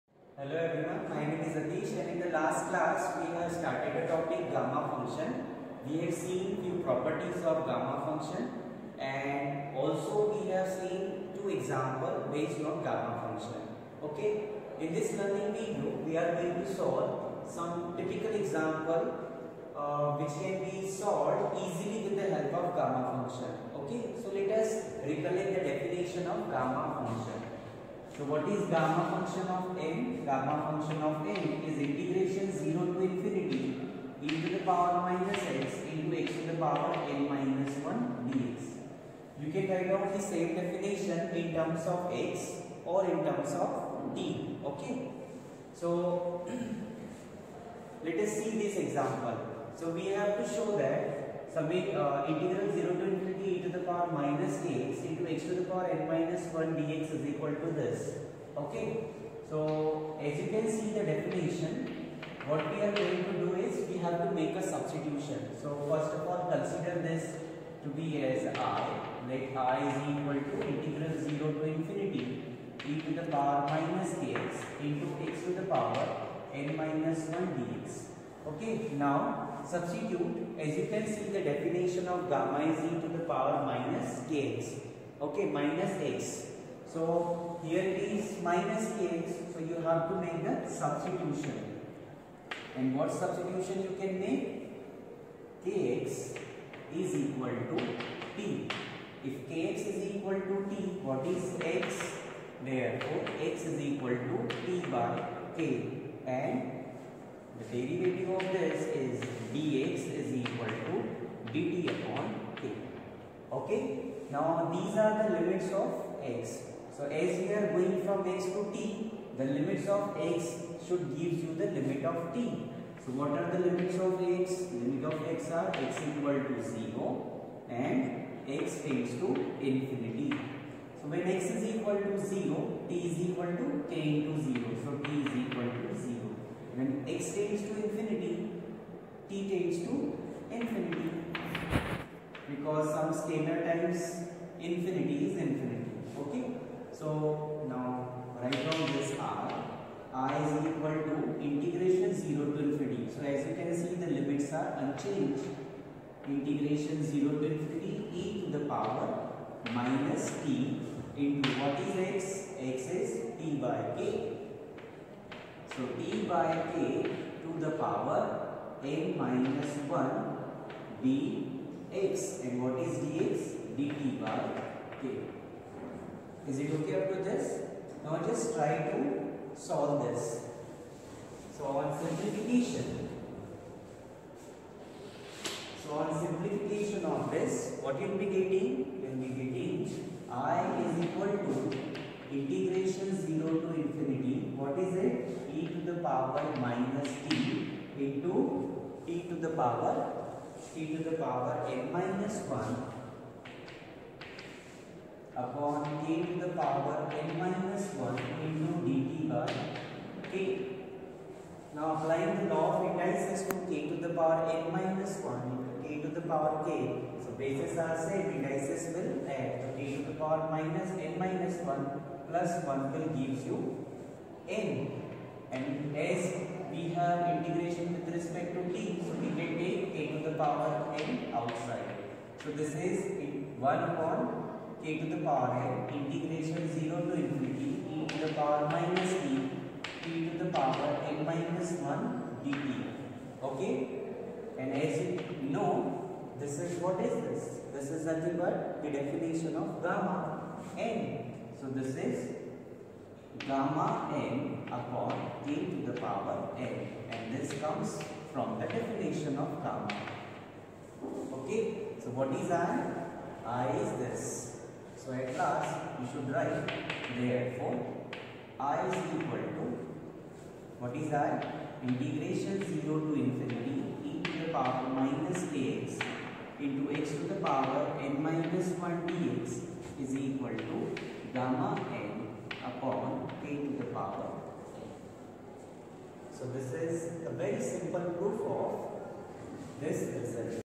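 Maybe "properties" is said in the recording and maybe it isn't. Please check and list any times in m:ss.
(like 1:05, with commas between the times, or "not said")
0:06.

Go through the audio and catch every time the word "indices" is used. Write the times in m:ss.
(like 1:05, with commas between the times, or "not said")
3:32, 3:38.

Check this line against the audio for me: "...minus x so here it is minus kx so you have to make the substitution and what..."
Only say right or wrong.
right.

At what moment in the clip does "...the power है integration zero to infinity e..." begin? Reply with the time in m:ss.
3:55.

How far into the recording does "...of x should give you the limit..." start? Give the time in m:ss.
1:59.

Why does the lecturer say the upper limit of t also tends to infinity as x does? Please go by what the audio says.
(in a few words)
Scalar times infinity is infinity.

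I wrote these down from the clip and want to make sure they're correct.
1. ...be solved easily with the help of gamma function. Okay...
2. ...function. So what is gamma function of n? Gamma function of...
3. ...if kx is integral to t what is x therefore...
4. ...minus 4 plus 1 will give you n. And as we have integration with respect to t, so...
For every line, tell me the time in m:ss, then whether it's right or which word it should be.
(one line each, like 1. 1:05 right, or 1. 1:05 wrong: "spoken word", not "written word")
1. 0:20 right
2. 0:27 right
3. 1:39 wrong: "equal", not "integral"
4. 3:41 wrong: "1", not "4".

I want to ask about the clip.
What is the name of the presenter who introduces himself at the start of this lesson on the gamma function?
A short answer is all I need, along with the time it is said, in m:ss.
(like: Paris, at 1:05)
Atish, at 0:01.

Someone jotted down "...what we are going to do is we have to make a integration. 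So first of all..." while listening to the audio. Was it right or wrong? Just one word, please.
wrong.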